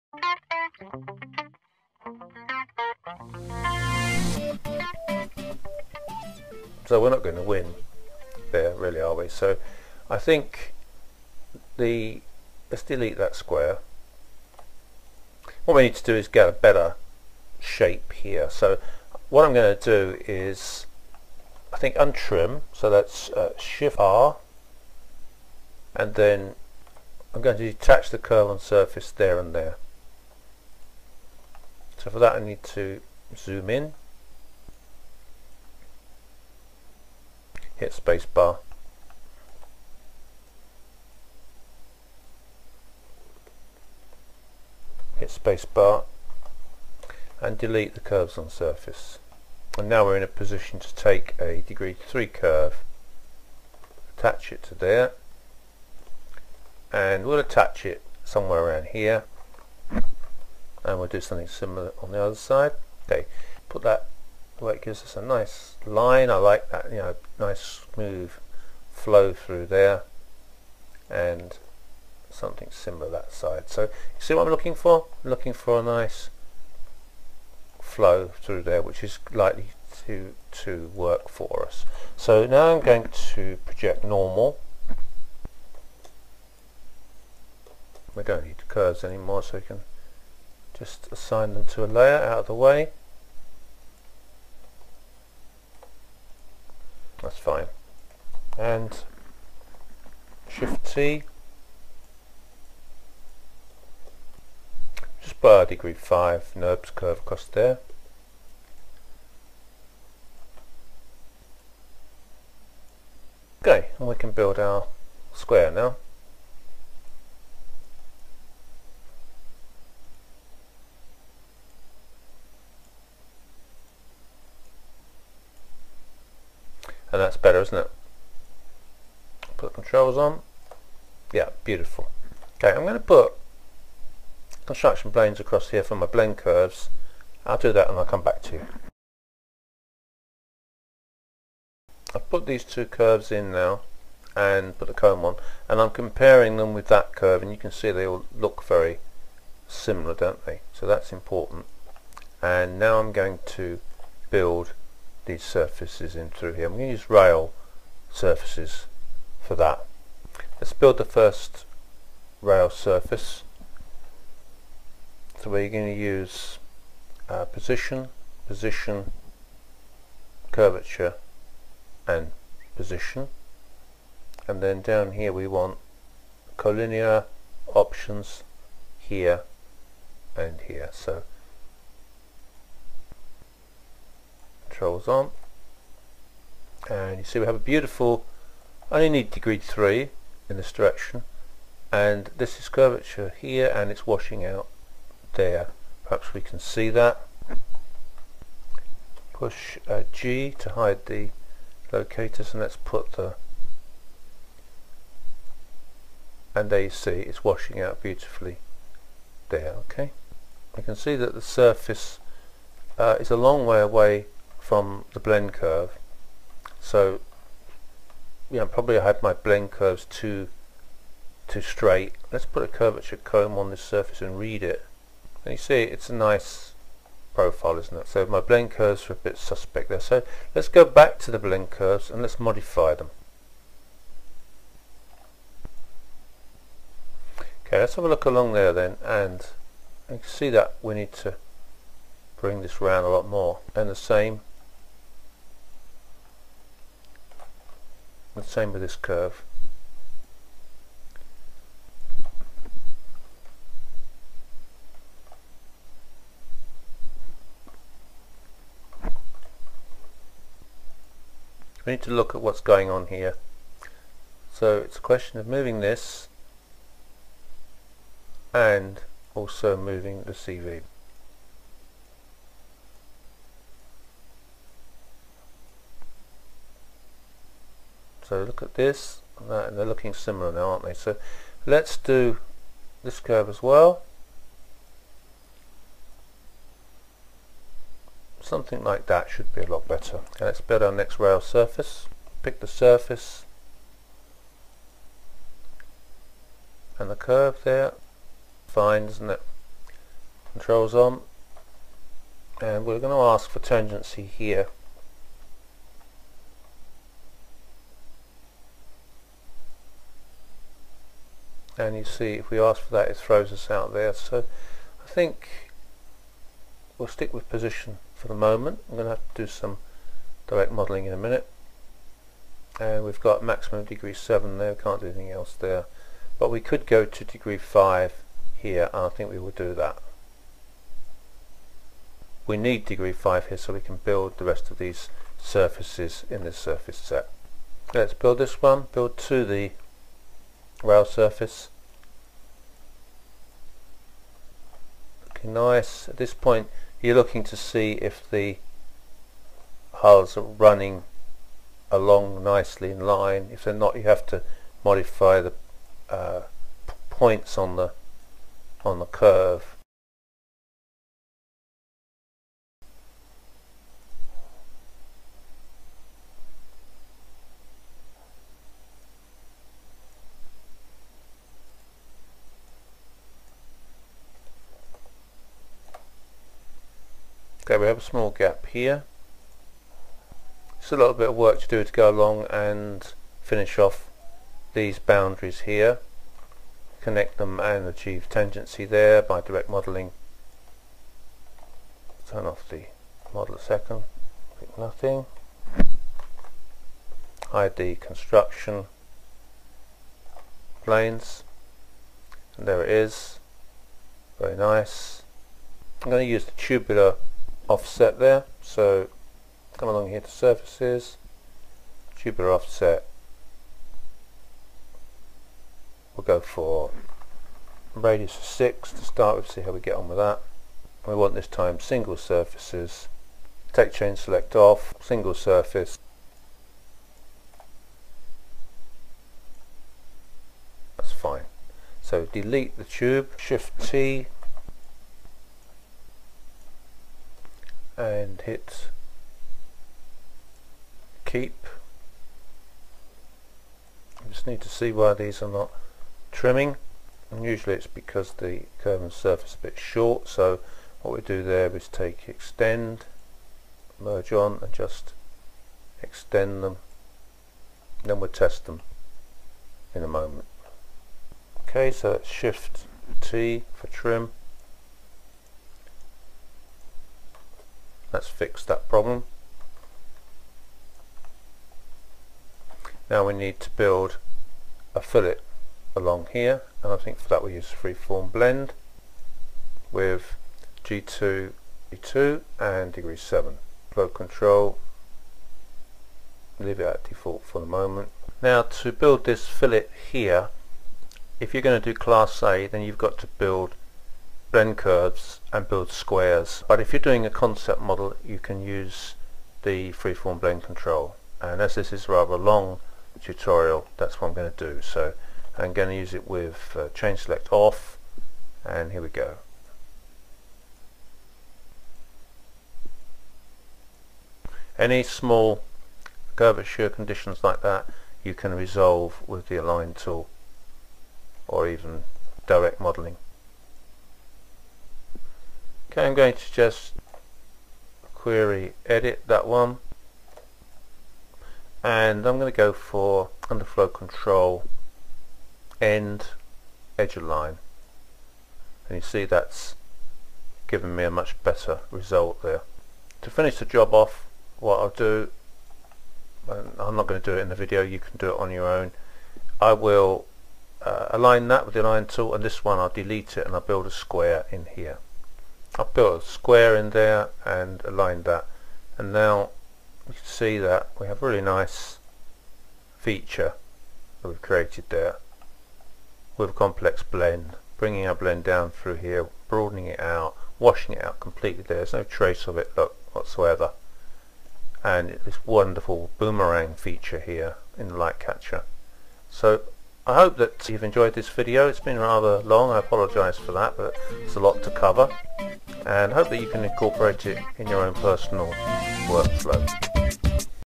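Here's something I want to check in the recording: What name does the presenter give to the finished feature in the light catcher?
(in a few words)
Boomerang feature.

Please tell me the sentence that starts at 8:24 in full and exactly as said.
So I'm going to use it with uh, select off, and here we go.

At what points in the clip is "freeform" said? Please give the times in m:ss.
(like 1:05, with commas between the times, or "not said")
7:57, 8:19.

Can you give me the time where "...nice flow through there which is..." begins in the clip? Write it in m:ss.
1:15.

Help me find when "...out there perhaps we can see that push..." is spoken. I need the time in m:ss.
3:14.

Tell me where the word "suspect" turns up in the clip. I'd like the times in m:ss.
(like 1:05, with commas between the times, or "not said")
3:49.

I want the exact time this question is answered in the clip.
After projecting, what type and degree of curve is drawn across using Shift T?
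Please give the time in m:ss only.
1:45.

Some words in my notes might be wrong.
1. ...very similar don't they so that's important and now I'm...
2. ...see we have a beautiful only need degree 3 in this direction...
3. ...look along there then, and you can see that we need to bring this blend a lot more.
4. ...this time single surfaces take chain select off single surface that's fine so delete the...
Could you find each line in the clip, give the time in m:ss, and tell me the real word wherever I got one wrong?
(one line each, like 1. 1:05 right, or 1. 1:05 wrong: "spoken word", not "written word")
1. 2:28 right
2. 3:07 right
3. 3:58 wrong: "round", not "blend"
4. 7:01 right.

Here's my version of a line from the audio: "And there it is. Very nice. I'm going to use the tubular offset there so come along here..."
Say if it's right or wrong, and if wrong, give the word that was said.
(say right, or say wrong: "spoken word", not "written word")
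right.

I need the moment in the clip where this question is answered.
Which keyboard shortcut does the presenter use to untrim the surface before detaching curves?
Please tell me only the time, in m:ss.
0:23.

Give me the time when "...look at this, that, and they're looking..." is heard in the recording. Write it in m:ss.
4:38.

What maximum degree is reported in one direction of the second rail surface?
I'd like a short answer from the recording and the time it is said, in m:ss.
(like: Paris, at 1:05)
7, at 5:23.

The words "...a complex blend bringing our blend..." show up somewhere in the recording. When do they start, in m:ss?
9:26.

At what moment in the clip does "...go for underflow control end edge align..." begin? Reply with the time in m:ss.
8:52.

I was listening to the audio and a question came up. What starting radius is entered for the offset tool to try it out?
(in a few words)
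6.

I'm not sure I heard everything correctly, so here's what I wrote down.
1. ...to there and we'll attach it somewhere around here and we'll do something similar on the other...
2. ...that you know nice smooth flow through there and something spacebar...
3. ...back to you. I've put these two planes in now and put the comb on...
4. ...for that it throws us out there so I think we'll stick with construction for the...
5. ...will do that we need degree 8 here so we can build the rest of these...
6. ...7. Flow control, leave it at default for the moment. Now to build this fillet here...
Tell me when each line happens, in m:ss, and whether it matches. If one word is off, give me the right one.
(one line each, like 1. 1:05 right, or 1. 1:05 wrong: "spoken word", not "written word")
1. 0:54 right
2. 1:06 wrong: "similar", not "spacebar"
3. 2:18 wrong: "curves", not "planes"
4. 5:12 wrong: "position", not "construction"
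5. 5:29 wrong: "5", not "8"
6. 8:03 right.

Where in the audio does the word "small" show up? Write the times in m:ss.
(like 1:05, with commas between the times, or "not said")
6:18, 8:35.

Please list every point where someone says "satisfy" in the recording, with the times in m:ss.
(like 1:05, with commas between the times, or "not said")
not said.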